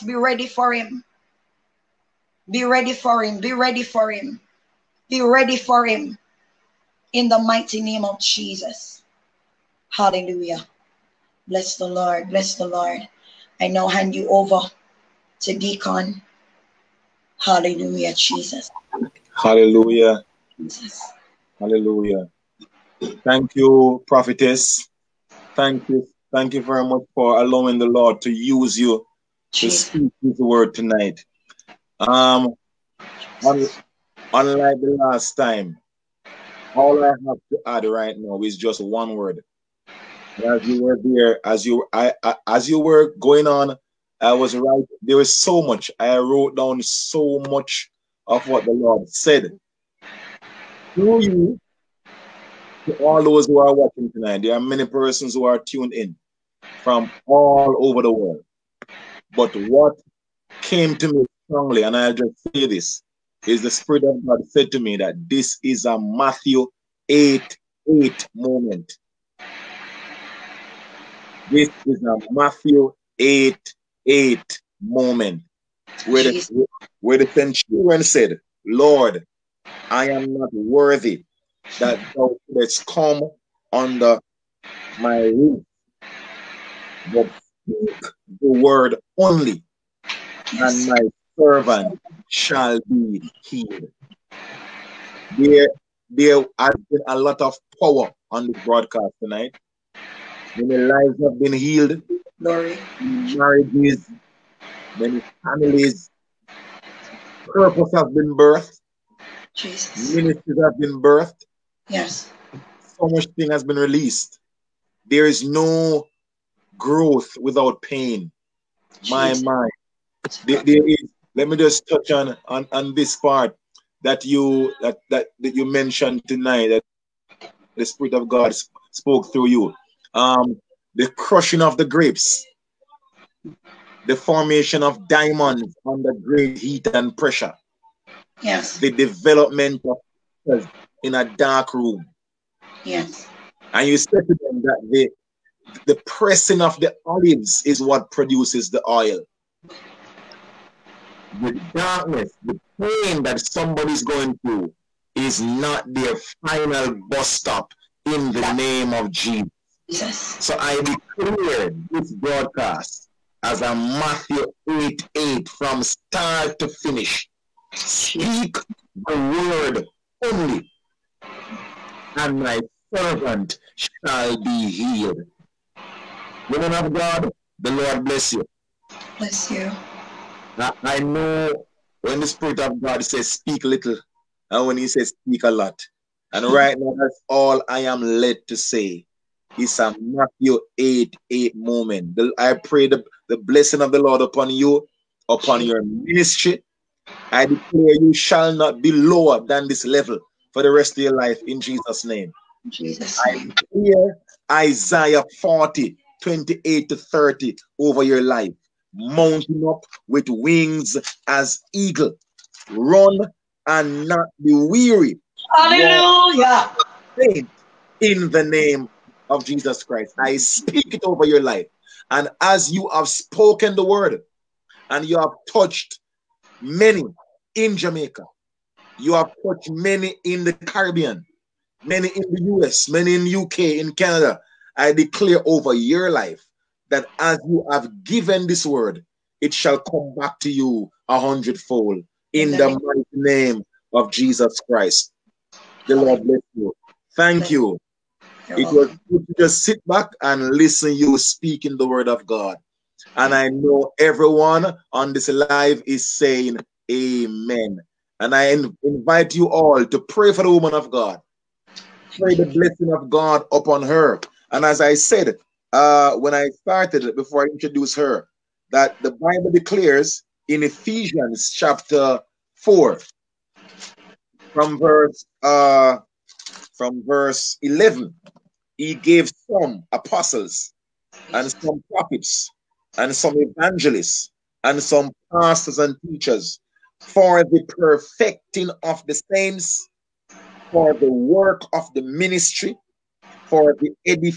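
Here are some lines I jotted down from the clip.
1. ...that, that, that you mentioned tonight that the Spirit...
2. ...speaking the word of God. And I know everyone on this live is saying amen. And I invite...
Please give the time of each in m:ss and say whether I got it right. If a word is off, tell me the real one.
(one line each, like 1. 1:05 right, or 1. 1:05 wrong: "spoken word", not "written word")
1. 2:04 right
2. 4:11 right.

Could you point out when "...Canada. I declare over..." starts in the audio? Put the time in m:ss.
3:53.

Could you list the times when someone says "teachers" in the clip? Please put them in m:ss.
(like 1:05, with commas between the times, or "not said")
4:46.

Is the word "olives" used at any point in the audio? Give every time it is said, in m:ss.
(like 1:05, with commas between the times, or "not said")
2:27.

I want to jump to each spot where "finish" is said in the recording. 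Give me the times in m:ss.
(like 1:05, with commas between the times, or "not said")
2:46.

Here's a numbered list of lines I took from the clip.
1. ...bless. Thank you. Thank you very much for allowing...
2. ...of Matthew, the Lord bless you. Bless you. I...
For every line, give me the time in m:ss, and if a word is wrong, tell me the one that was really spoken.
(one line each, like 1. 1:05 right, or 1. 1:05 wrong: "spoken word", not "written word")
1. 0:24 wrong: "prophetess", not "bless"
2. 2:56 wrong: "God", not "Matthew".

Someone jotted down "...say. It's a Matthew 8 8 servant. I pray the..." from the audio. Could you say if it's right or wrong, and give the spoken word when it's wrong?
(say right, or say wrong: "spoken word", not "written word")
wrong: "moment", not "servant".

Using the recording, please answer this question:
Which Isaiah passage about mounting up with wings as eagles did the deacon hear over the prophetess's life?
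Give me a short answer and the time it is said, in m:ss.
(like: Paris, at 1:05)
Isaiah 40:28-30, at 3:24.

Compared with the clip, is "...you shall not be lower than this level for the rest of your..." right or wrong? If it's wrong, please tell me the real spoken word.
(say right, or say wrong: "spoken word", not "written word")
right.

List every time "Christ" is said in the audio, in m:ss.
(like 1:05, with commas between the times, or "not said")
3:39, 4:04.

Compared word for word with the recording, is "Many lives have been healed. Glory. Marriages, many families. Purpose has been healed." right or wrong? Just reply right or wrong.
wrong.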